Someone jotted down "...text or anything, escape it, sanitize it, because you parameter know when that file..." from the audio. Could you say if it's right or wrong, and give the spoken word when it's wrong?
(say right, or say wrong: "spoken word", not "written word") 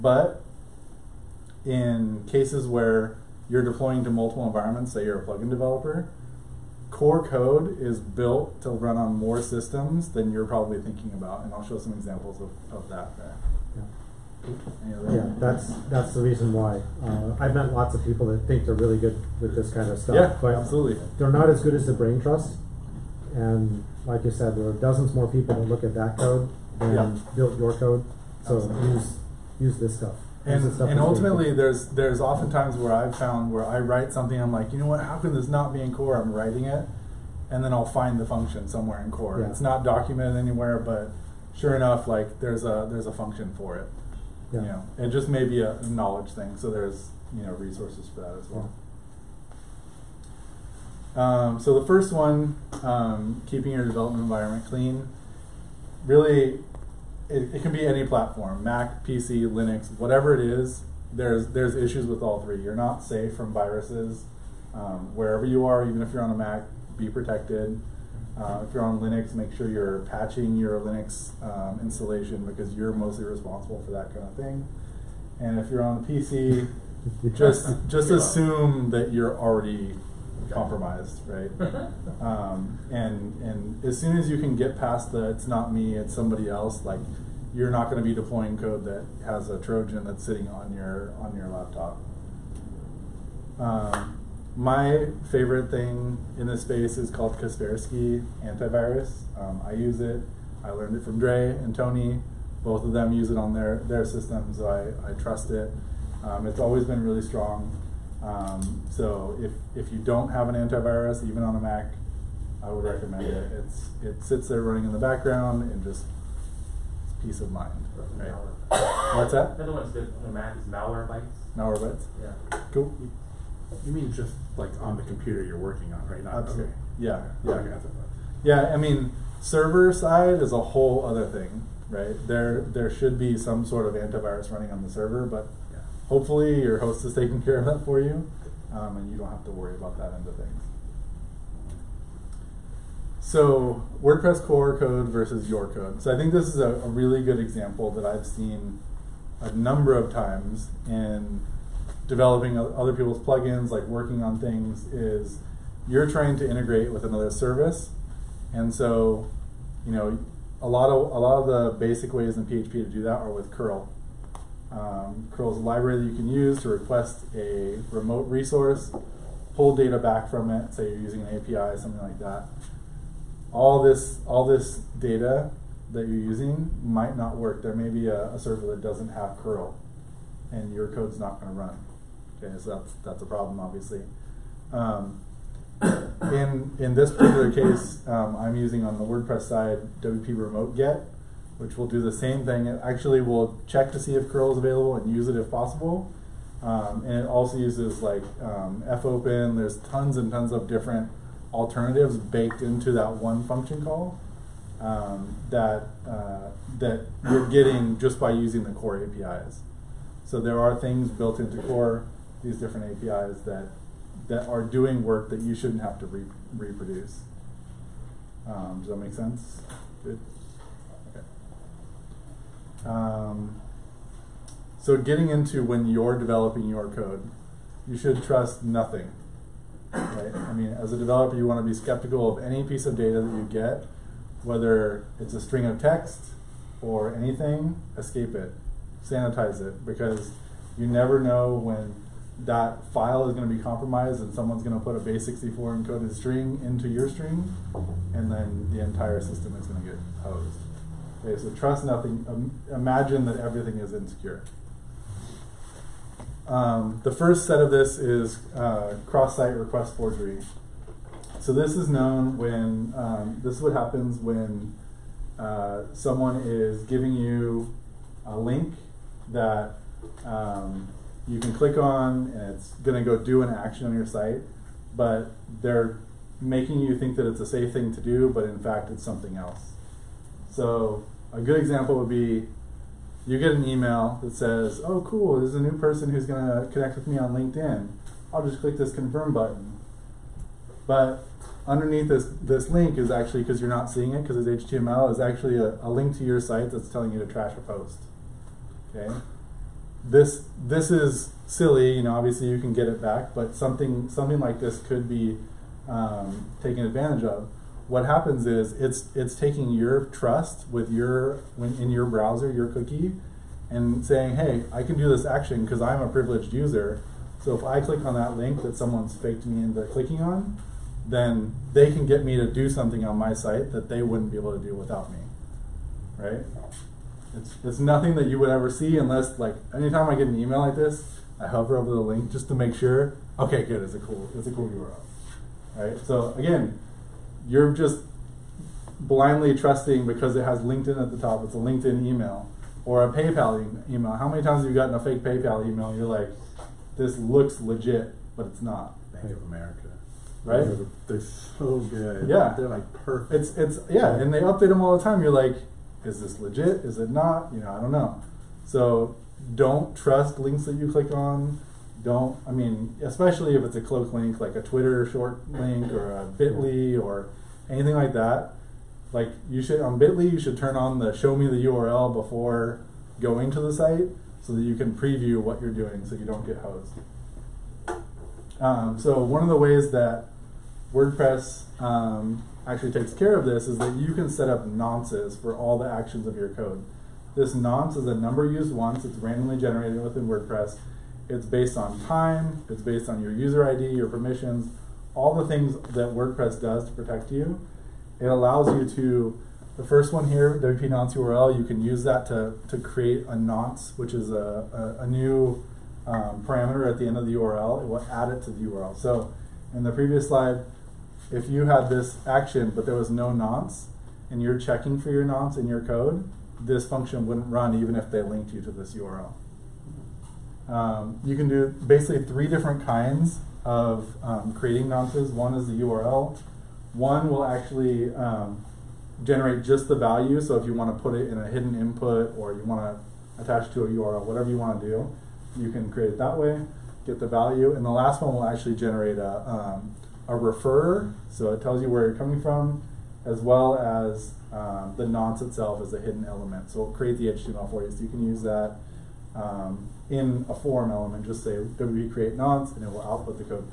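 wrong: "never", not "parameter".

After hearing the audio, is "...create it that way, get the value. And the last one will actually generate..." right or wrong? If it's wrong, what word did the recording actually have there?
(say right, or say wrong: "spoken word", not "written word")
right.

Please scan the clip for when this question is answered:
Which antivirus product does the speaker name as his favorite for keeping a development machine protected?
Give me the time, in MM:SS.
01:37.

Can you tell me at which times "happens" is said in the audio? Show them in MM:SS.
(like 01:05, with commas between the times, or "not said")
04:23, 05:08.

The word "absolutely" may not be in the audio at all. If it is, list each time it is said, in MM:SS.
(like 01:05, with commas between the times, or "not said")
00:20, 02:06.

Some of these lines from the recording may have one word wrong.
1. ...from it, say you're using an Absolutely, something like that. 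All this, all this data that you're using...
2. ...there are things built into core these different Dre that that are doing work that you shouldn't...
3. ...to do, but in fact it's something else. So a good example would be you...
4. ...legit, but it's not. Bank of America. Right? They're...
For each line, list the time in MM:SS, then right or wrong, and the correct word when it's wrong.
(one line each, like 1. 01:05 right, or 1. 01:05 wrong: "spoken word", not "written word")
1. 02:50 wrong: "API", not "Absolutely"
2. 03:30 wrong: "APIs", not "Dre"
3. 04:37 right
4. 05:47 right.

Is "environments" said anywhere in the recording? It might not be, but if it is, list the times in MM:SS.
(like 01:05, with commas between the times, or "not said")
00:04, 00:54.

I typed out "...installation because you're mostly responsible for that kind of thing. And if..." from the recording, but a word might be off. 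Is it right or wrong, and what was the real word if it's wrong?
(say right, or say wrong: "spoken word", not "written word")
right.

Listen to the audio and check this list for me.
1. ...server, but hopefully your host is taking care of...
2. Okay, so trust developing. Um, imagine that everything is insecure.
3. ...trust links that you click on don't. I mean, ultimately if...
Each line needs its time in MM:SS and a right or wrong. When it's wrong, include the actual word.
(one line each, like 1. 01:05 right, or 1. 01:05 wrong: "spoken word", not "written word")
1. 02:14 right
2. 04:11 wrong: "nothing", not "developing"
3. 05:59 wrong: "especially", not "ultimately".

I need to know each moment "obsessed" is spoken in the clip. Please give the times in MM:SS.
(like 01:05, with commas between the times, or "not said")
not said.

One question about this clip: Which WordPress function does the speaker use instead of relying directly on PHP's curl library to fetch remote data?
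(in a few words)
WP Remote Get.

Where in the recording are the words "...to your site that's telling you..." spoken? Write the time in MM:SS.
04:56.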